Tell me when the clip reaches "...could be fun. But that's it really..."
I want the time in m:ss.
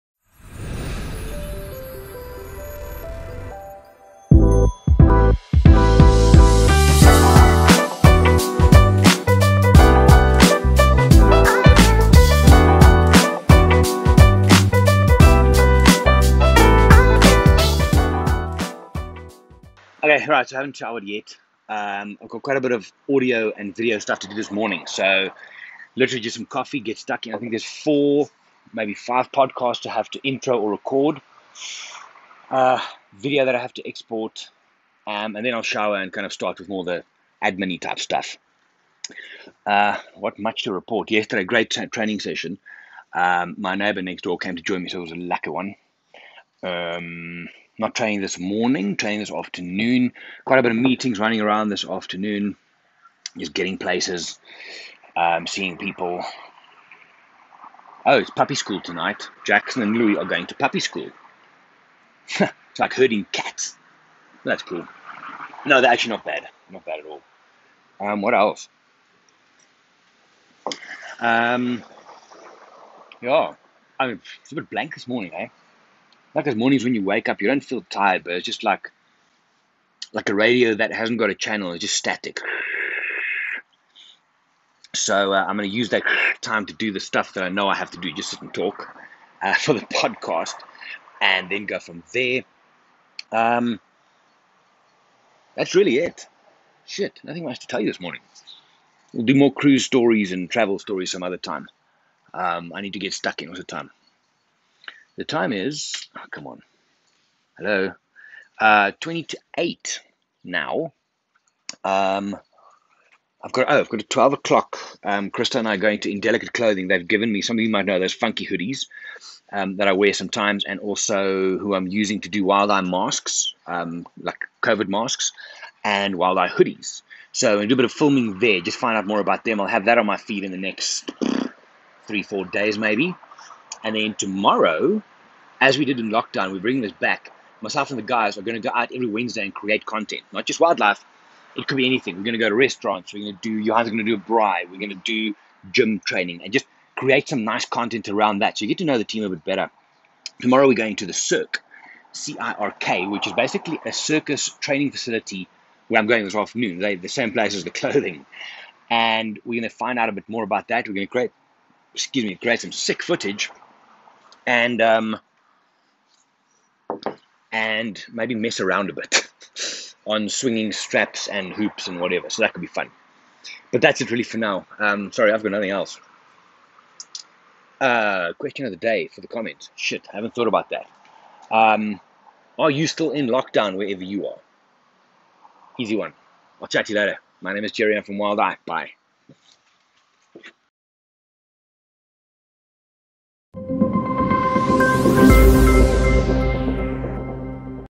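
2:52.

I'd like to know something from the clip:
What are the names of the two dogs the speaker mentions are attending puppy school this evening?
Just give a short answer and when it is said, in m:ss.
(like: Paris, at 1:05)
Jackson and Louis, at 0:59.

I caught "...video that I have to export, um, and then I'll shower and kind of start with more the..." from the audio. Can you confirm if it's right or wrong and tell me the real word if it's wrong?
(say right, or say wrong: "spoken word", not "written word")
right.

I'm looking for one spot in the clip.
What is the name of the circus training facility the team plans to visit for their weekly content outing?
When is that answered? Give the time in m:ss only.
2:31.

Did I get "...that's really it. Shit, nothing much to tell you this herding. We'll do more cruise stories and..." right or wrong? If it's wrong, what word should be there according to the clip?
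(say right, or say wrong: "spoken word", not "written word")
wrong: "morning", not "herding".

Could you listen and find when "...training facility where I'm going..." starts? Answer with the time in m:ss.
2:34.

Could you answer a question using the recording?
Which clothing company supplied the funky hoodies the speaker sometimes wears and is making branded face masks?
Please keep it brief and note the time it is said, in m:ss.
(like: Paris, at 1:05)
Indelicate Clothing, at 1:56.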